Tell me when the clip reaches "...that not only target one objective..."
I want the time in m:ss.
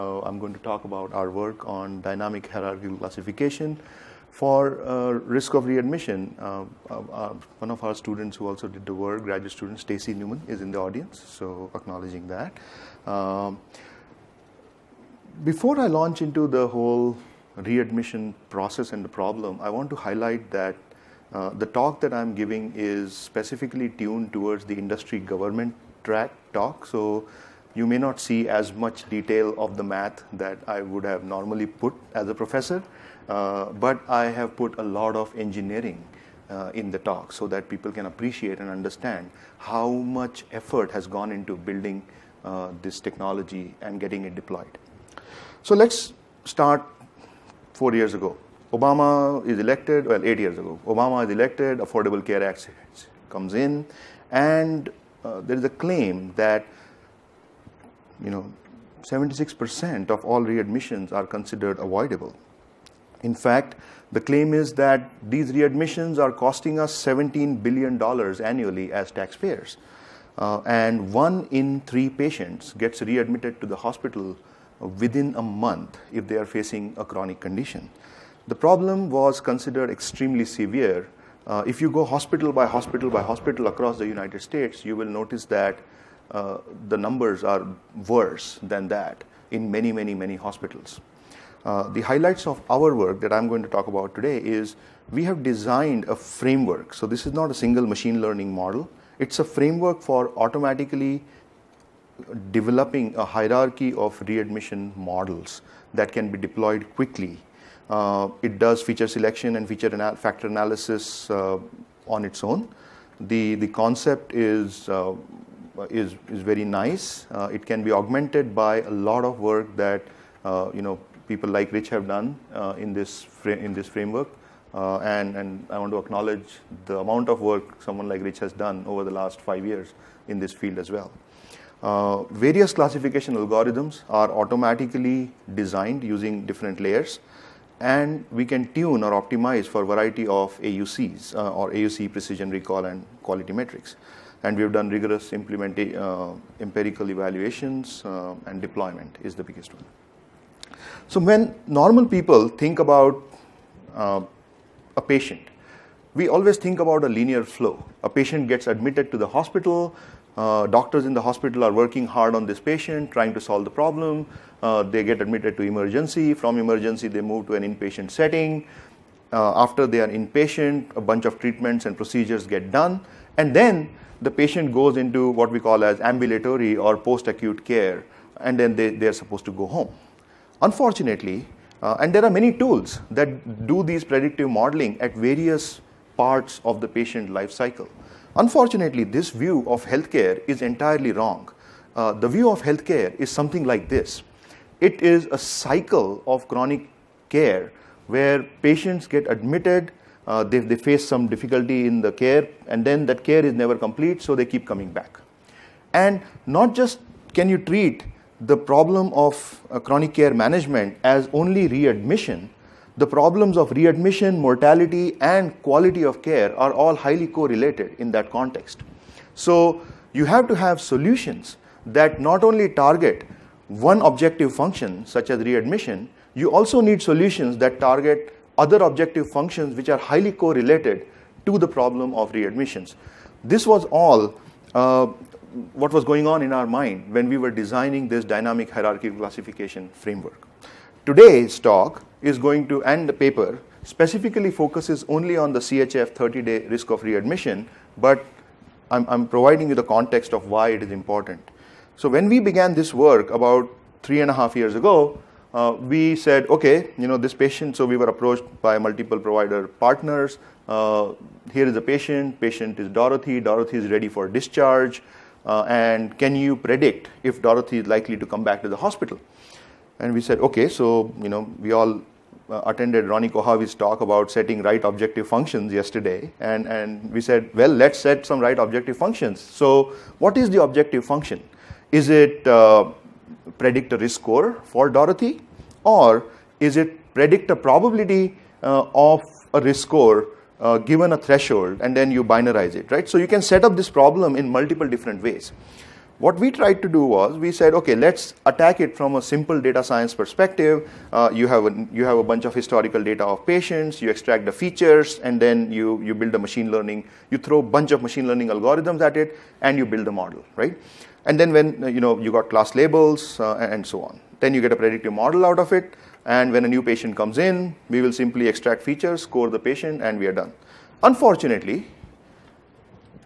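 3:41.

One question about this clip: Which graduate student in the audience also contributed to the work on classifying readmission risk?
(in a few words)
Stacey Newman.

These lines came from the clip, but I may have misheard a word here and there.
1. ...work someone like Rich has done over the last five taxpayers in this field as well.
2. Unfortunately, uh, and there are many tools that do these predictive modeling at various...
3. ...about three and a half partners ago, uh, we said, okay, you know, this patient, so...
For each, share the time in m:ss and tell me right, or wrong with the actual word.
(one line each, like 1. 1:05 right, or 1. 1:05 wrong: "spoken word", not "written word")
1. 2:07 wrong: "years", not "taxpayers"
2. 3:00 right
3. 4:13 wrong: "years", not "partners".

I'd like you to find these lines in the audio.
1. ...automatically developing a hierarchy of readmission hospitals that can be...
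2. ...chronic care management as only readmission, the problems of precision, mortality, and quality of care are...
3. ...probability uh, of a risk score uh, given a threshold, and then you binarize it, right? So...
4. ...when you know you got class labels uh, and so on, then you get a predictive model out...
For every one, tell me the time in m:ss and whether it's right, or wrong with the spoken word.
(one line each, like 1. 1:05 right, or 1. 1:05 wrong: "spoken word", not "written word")
1. 1:40 wrong: "models", not "hospitals"
2. 3:29 wrong: "readmission", not "precision"
3. 4:47 right
4. 5:11 right.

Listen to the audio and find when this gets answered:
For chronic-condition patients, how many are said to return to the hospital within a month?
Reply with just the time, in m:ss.
1:11.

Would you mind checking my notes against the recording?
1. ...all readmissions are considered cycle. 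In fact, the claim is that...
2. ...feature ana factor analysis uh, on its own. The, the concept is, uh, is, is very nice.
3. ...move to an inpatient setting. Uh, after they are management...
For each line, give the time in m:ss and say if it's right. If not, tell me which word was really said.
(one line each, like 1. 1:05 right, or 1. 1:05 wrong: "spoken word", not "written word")
1. 1:00 wrong: "avoidable", not "cycle"
2. 1:49 right
3. 2:47 wrong: "inpatient", not "management".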